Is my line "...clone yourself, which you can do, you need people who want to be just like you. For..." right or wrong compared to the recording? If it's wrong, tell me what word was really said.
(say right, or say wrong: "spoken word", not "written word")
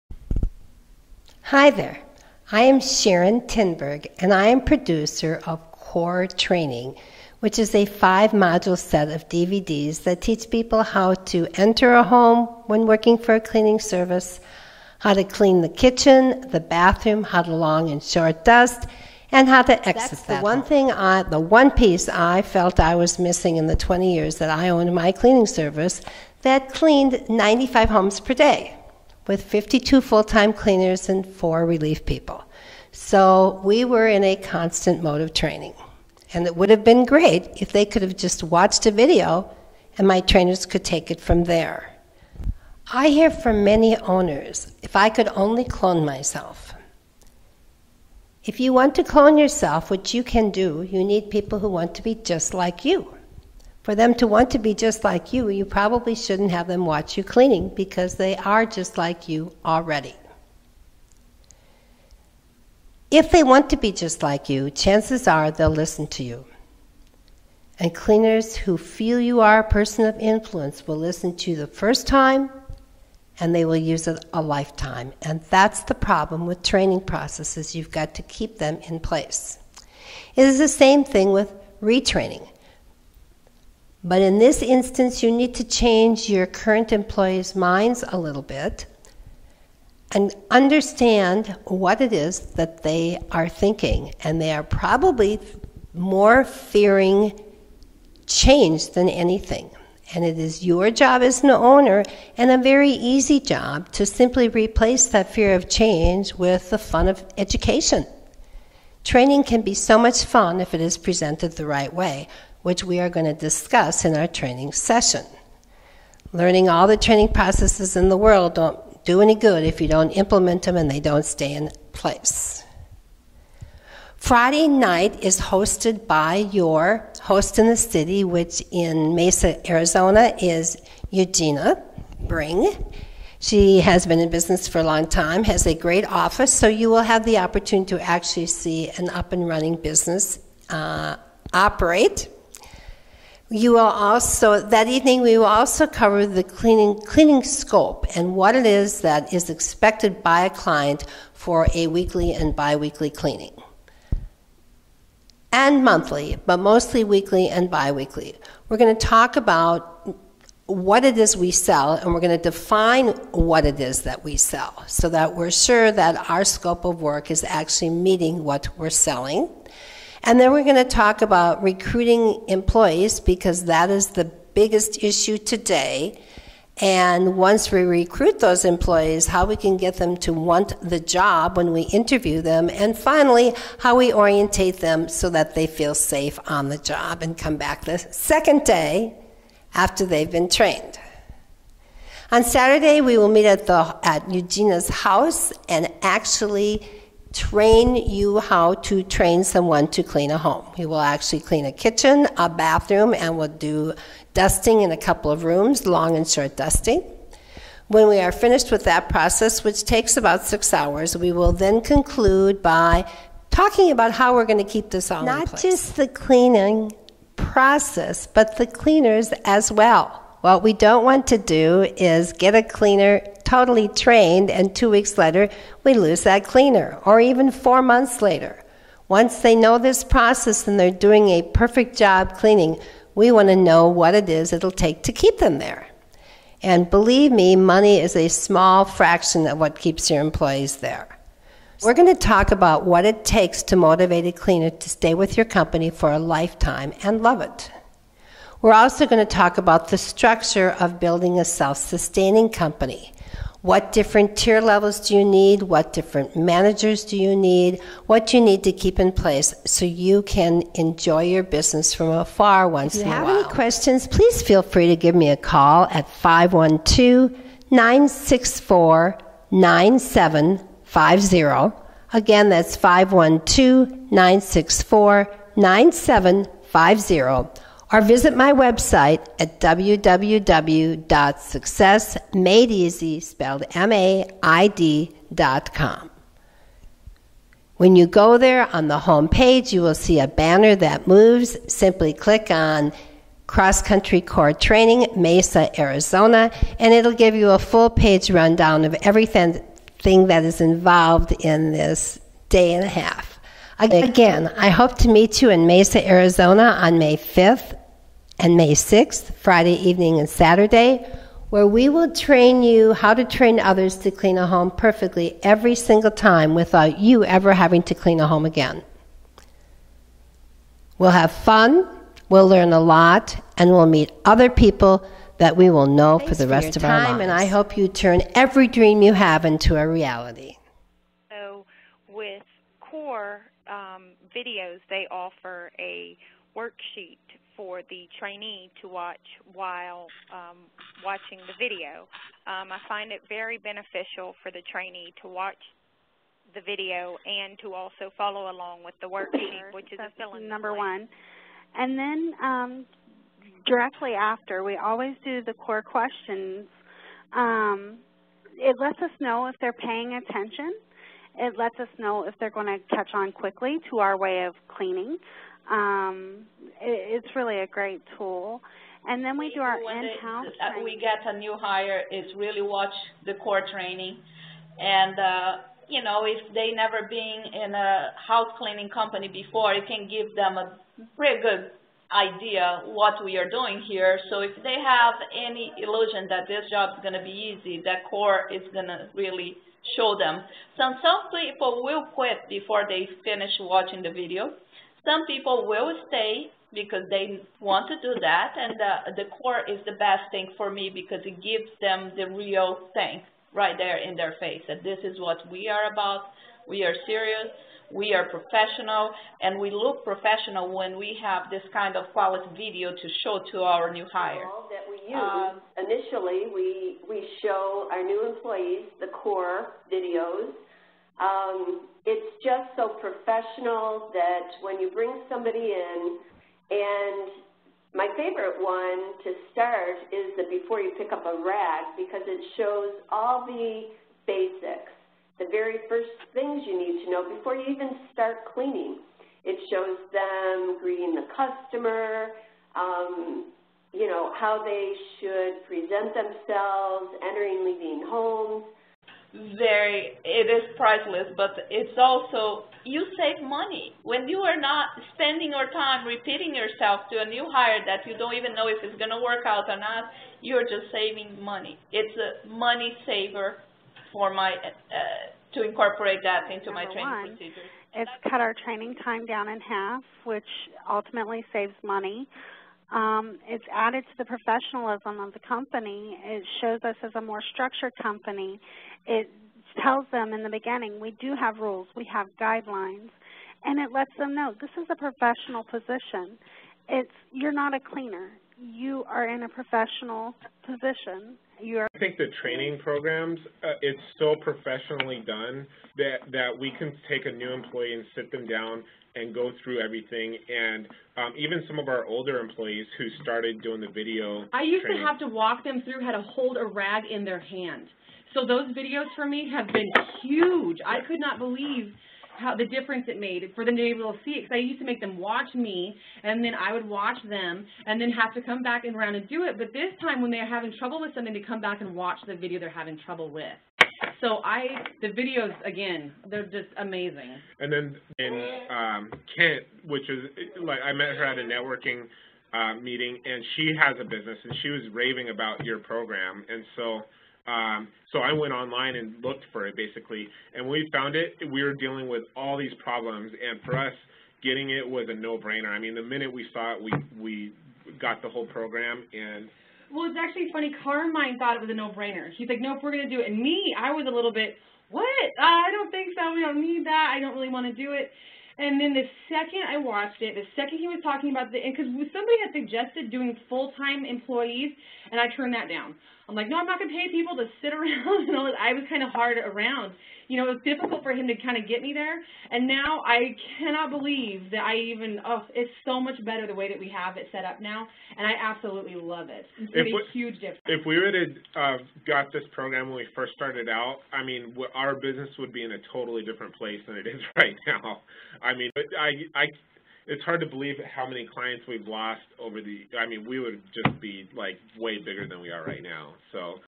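right.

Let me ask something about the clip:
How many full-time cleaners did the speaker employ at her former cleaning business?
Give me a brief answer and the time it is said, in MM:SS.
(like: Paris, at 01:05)
52, at 00:29.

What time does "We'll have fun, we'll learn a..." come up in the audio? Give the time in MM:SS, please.
05:20.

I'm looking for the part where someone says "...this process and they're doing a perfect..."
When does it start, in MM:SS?
03:49.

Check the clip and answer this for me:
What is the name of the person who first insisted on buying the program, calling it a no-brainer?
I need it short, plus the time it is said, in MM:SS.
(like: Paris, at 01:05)
Carmine, at 09:10.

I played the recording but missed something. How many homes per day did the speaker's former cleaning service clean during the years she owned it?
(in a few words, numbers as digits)
95.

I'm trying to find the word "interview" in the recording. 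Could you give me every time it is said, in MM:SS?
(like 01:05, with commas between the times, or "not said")
03:01.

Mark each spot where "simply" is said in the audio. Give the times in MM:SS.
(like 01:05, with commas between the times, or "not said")
01:44, 04:51.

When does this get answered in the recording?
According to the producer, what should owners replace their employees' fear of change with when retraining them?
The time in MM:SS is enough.
01:46.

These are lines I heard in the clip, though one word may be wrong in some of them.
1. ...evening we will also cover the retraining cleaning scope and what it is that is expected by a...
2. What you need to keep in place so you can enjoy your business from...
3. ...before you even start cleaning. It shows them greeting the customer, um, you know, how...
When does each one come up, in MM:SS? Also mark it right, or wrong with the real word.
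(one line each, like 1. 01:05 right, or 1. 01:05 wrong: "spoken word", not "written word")
1. 02:24 wrong: "cleaning", not "retraining"
2. 04:18 right
3. 07:17 right.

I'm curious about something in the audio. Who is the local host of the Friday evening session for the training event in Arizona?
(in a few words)
Eugenia Bring.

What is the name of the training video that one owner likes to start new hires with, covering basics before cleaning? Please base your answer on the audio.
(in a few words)
Before You Pick Up a Rag.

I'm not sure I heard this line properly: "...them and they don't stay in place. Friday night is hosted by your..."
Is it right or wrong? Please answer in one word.
right.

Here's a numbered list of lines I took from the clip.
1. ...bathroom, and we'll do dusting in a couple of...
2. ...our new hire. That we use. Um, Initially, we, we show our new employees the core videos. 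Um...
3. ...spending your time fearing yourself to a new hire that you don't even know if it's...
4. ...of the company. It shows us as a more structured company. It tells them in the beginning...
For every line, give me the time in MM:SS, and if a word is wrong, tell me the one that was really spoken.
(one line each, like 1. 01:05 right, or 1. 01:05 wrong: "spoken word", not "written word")
1. 03:22 right
2. 06:53 right
3. 07:35 wrong: "repeating", not "fearing"
4. 07:55 right.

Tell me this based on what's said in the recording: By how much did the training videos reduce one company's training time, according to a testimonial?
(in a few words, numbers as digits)
In half.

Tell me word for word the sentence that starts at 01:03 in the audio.
If they want to be just like you, chances are they'll listen to you.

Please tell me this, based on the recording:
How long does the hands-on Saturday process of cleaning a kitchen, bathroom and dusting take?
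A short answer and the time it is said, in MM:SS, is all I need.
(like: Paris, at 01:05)
About 6 hours, at 03:30.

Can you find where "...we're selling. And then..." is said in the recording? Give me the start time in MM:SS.
02:48.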